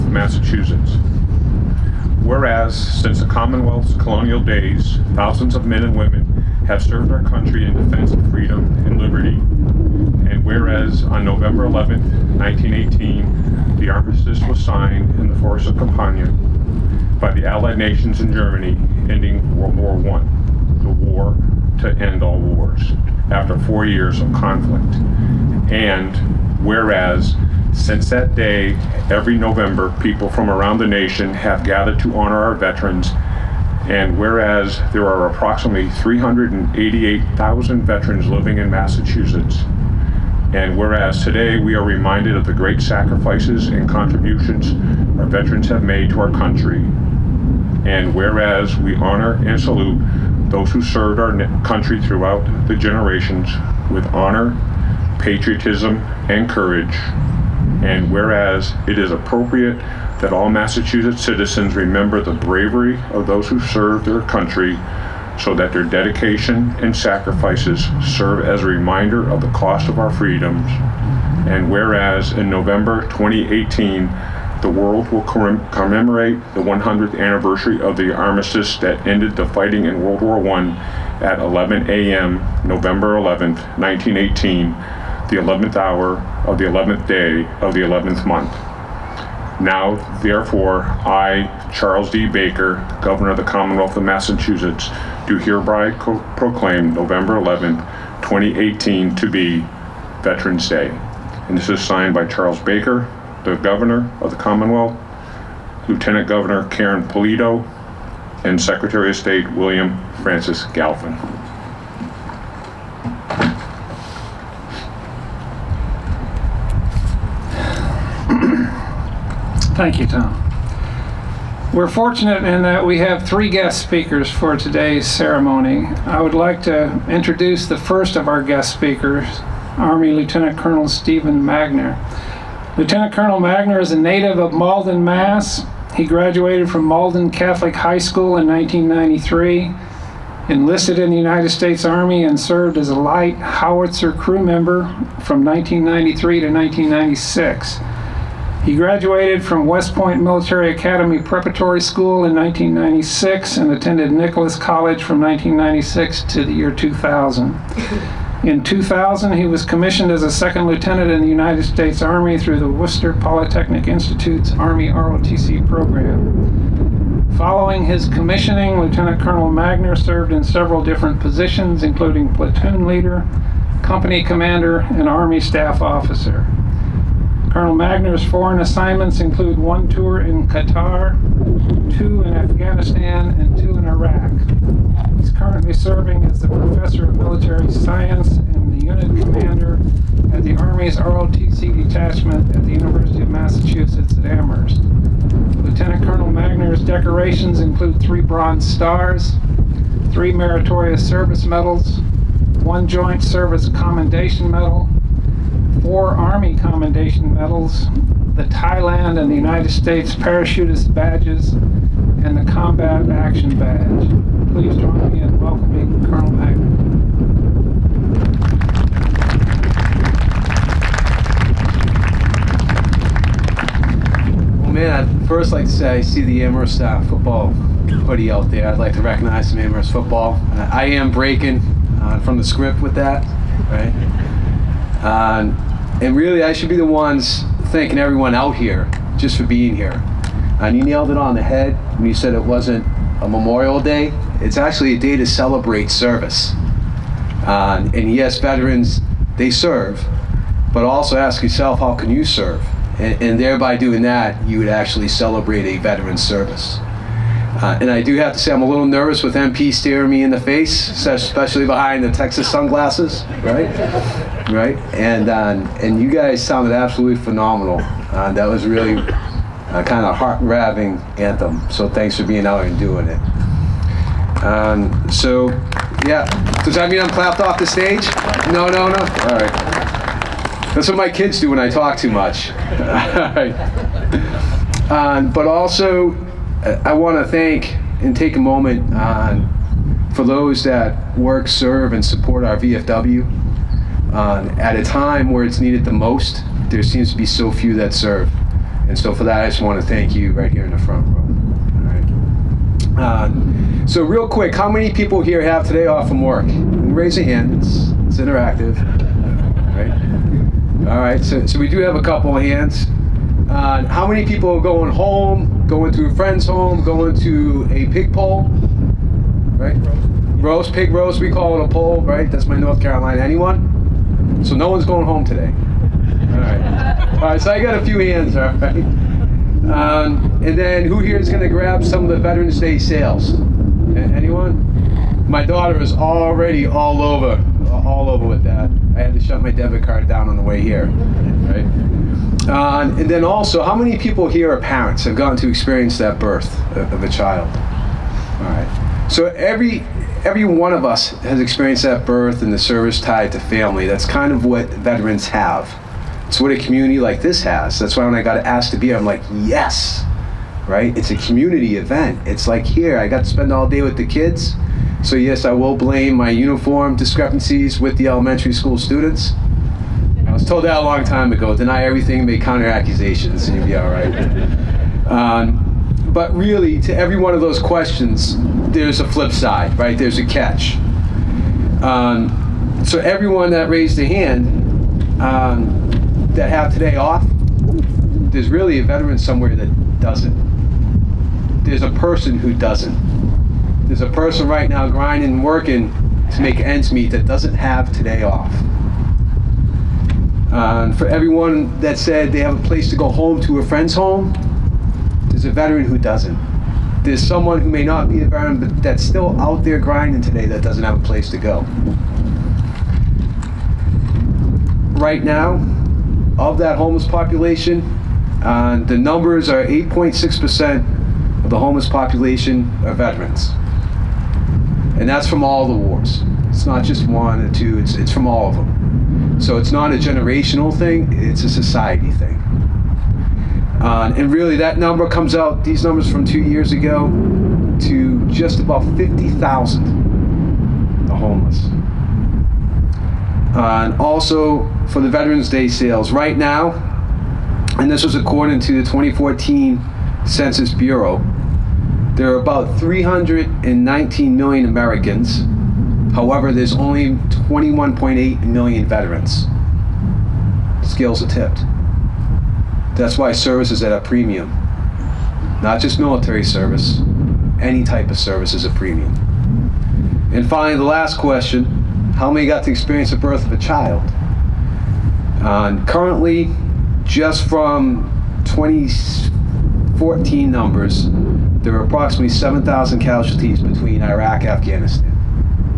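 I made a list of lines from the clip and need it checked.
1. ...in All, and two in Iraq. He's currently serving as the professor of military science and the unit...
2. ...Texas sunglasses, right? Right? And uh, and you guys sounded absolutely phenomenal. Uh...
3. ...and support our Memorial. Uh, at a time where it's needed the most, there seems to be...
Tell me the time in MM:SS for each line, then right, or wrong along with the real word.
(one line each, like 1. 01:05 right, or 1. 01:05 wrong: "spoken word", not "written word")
1. 03:02 wrong: "Afghanistan", not "All"
2. 04:22 right
3. 04:51 wrong: "VFW", not "Memorial".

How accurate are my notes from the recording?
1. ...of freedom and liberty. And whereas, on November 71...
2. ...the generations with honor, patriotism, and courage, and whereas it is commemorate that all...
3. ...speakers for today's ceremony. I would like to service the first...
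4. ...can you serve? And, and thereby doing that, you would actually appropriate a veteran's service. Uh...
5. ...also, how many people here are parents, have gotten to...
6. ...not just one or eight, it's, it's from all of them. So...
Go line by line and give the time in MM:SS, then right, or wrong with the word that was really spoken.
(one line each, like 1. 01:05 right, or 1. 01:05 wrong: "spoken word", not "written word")
1. 00:08 wrong: "11", not "71"
2. 00:52 wrong: "appropriate", not "commemorate"
3. 02:03 wrong: "introduce", not "service"
4. 04:11 wrong: "celebrate", not "appropriate"
5. 05:43 right
6. 07:06 wrong: "two", not "eight".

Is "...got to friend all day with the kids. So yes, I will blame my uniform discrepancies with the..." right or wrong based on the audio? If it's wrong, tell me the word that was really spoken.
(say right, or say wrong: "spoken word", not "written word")
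wrong: "spend", not "friend".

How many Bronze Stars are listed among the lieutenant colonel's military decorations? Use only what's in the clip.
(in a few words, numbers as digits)
3.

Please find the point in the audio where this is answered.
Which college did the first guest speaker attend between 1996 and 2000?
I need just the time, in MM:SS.
02:34.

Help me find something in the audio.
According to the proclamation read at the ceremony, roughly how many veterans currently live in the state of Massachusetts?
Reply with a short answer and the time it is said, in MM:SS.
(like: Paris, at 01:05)
388,000, at 00:35.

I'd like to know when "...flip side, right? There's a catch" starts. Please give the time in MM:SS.
06:19.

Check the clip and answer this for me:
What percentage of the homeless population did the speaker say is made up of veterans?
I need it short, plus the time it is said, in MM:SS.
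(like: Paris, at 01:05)
8.6%, at 06:59.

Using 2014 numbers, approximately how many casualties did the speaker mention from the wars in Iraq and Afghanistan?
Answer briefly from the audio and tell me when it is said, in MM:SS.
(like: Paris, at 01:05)
7,000, at 08:01.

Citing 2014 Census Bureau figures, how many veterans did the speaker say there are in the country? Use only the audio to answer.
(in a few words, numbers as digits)
21.8 million.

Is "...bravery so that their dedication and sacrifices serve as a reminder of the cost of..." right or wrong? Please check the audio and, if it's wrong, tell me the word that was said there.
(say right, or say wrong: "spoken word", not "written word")
wrong: "country", not "bravery".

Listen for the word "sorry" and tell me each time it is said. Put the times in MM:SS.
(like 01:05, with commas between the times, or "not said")
not said.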